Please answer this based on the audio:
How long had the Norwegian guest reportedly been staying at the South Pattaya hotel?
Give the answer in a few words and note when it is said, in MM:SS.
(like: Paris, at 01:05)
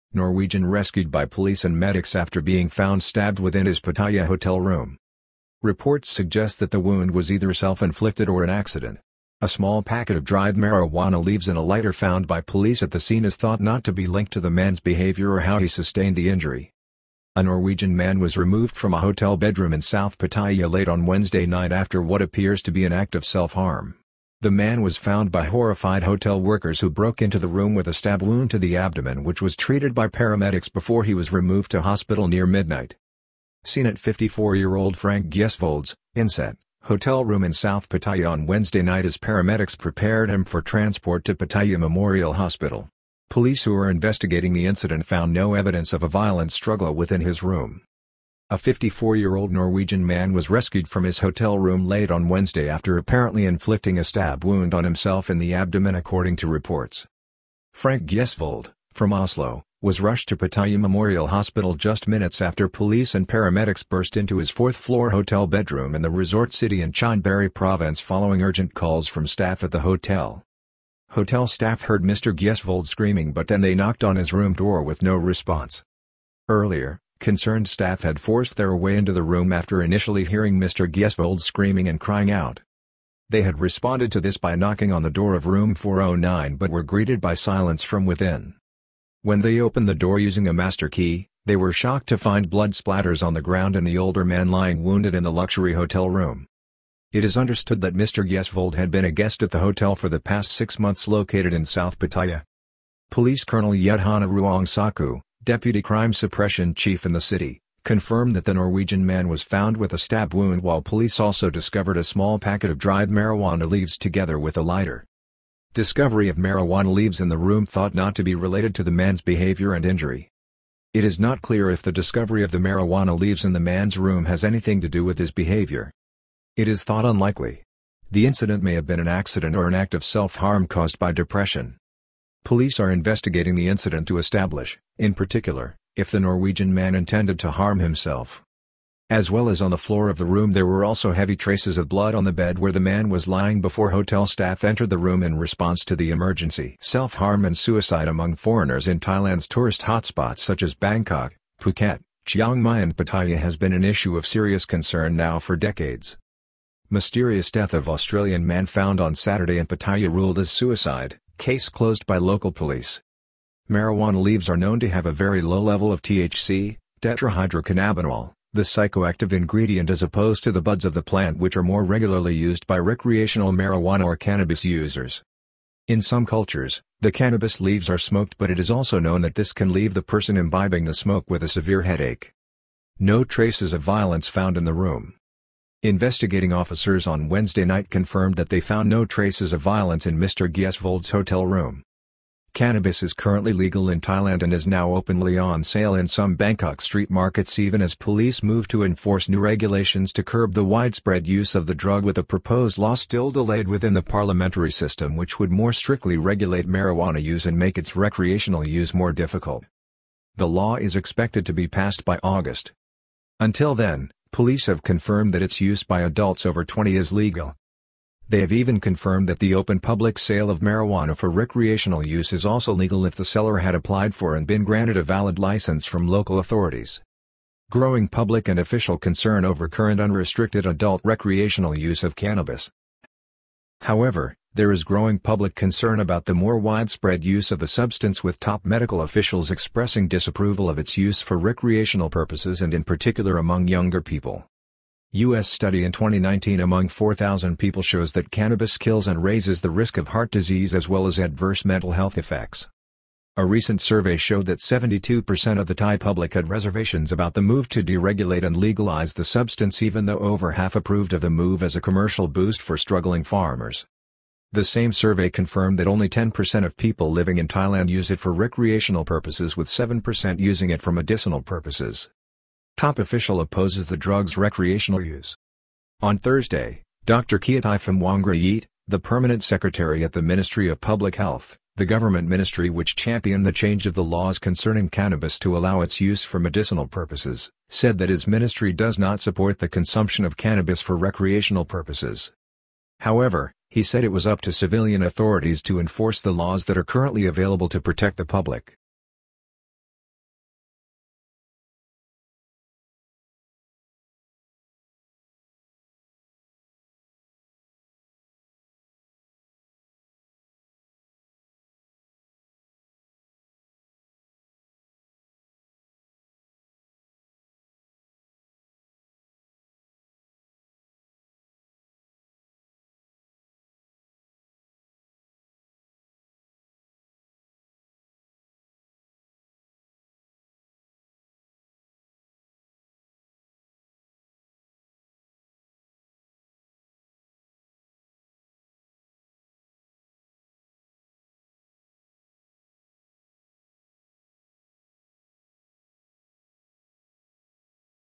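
six months, at 01:40.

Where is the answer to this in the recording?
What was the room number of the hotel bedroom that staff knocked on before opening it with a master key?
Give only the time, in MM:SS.
01:25.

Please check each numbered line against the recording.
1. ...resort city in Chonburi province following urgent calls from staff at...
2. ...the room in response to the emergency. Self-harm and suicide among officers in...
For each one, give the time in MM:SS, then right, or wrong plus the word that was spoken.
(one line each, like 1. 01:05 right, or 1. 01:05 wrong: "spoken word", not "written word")
1. 01:06 right
2. 02:24 wrong: "foreigners", not "officers".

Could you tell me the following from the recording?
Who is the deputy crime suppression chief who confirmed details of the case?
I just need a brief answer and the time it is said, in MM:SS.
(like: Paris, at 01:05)
Yedhana Ruang Saku, at 01:43.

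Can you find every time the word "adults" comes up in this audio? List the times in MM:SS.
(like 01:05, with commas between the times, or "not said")
03:36, 03:50.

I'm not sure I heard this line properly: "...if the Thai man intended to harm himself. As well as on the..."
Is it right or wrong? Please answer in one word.
wrong.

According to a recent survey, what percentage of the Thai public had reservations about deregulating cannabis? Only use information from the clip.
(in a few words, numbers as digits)
72%.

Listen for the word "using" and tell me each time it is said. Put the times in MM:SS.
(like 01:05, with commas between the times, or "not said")
01:30, 04:30.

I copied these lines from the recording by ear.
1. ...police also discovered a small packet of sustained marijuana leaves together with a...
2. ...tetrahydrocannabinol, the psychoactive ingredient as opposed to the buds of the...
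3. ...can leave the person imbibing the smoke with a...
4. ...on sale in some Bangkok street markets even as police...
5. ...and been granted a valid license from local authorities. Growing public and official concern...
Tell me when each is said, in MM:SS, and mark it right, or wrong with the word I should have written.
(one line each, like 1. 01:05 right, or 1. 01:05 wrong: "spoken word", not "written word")
1. 01:50 wrong: "dried", not "sustained"
2. 02:47 right
3. 02:59 right
4. 03:15 right
5. 03:44 right.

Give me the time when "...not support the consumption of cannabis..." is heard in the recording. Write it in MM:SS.
04:48.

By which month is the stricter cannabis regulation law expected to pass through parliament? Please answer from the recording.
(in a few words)
August.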